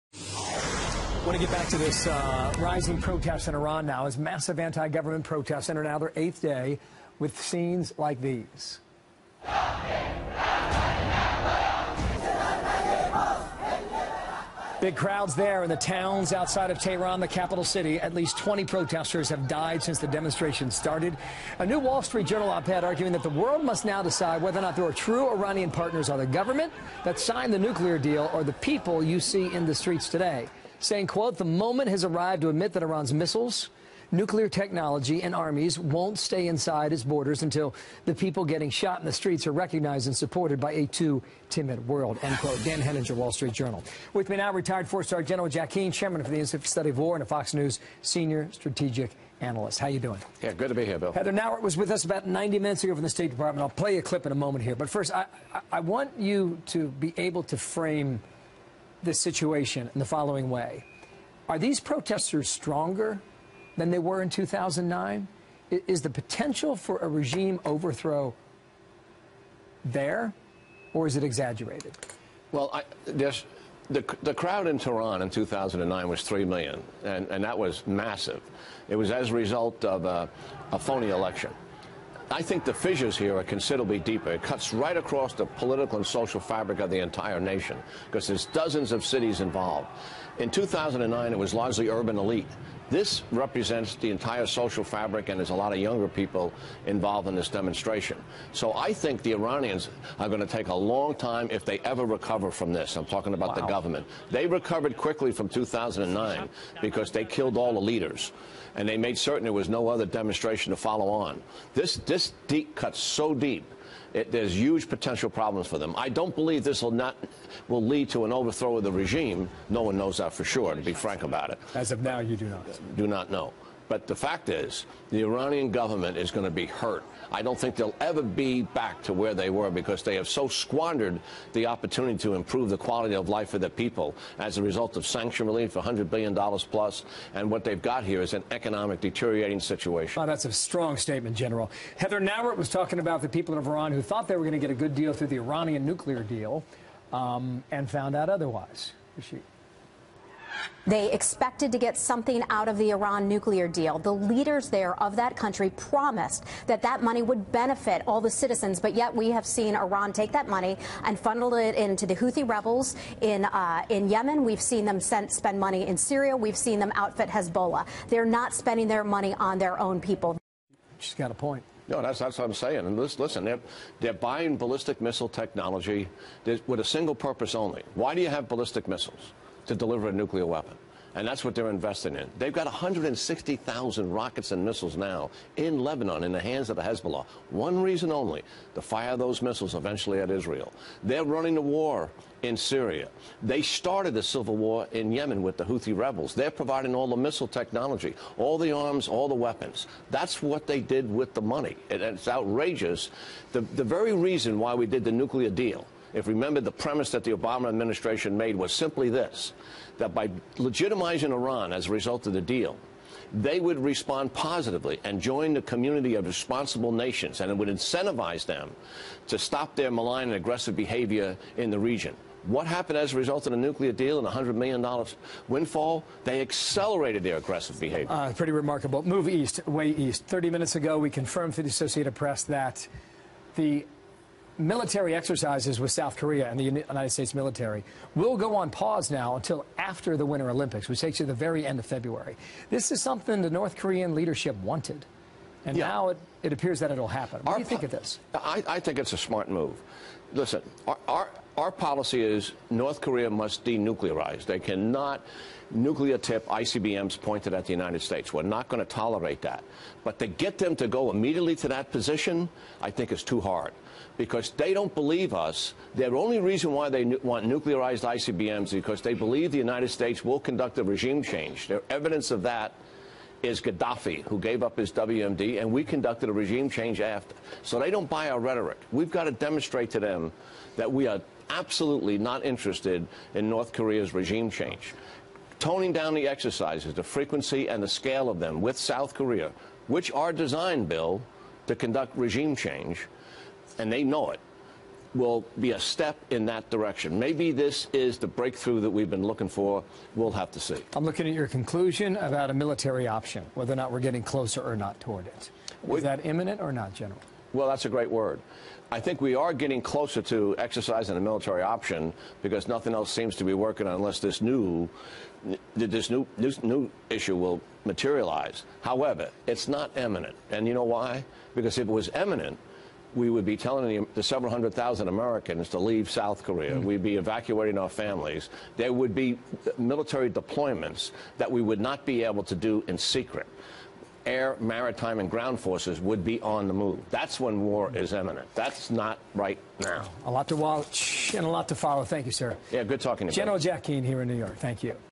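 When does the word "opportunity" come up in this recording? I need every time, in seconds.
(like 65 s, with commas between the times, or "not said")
131 s.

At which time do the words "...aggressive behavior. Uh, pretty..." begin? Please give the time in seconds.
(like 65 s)
227 s.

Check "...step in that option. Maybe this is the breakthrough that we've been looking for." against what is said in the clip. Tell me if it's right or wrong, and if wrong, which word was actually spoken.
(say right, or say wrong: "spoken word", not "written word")
wrong: "direction", not "option".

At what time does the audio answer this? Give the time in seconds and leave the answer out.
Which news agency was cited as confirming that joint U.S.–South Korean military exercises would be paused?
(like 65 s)
231 s.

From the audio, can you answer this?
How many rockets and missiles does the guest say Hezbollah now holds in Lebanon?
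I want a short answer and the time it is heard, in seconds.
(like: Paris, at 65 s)
160,000, at 182 s.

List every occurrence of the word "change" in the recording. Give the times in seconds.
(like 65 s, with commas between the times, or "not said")
271 s, 276 s, 284 s, 292 s.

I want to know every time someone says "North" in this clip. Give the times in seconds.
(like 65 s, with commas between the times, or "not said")
243 s, 252 s, 283 s.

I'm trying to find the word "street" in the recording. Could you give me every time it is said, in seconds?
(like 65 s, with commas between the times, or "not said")
22 s, 29 s, 39 s, 43 s.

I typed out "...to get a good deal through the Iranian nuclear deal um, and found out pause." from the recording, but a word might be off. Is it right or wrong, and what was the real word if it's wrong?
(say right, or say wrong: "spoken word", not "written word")
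wrong: "otherwise", not "pause".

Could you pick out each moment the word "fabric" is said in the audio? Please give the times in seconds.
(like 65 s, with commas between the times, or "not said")
86 s, 94 s.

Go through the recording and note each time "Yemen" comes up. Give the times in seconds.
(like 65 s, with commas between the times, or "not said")
164 s, 195 s.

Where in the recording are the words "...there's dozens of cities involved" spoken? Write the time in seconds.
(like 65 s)
88 s.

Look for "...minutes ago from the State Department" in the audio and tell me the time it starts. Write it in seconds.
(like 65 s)
52 s.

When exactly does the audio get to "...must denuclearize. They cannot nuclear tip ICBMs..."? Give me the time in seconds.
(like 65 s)
253 s.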